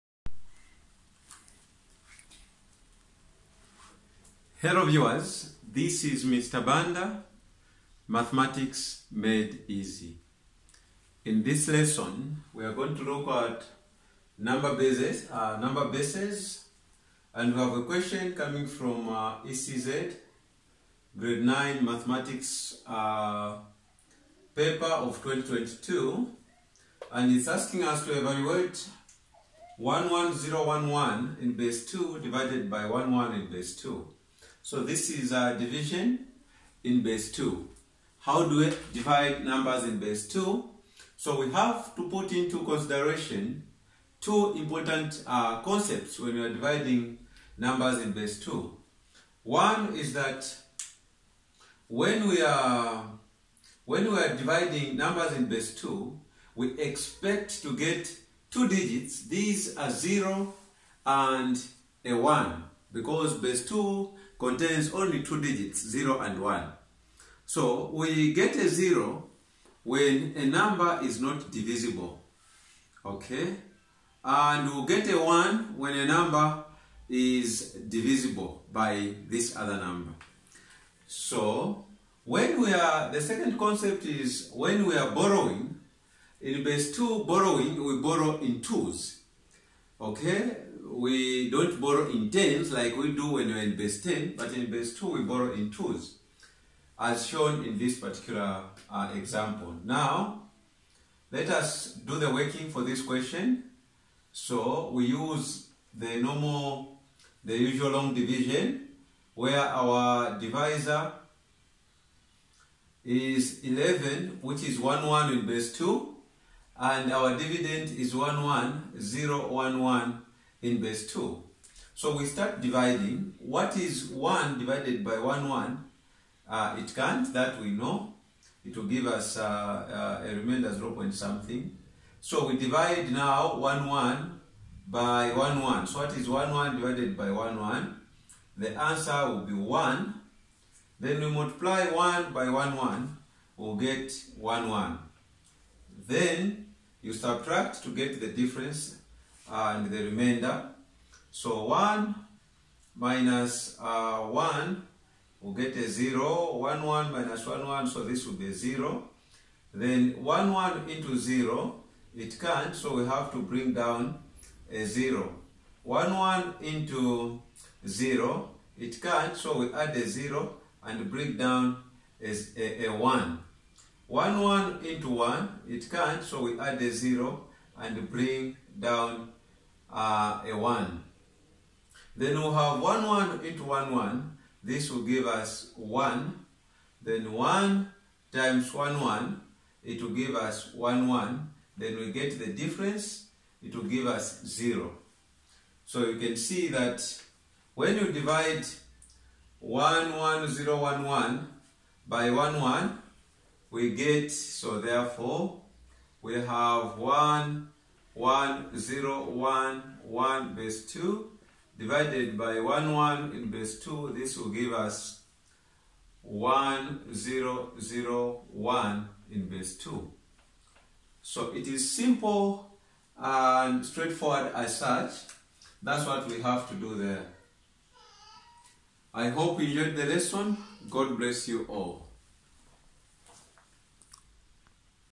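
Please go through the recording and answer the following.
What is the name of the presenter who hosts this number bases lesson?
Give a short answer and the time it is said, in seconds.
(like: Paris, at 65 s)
Mr. Banda, at 6 s.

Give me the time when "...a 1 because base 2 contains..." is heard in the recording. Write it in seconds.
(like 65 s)
62 s.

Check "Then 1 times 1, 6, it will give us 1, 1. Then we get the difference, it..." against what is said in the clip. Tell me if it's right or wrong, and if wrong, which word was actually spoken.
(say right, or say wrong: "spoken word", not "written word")
wrong: "1", not "6".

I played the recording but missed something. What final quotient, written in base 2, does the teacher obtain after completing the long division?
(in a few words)
1001.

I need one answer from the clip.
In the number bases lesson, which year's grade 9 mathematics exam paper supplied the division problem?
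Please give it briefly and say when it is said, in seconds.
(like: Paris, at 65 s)
2022, at 25 s.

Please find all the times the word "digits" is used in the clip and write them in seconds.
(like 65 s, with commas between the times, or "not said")
58 s, 65 s.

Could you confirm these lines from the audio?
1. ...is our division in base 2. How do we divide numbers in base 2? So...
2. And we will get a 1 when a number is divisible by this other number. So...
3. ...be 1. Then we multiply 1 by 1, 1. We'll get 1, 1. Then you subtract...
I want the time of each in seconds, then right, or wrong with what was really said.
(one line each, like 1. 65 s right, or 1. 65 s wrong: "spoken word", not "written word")
1. 35 s right
2. 74 s right
3. 139 s right.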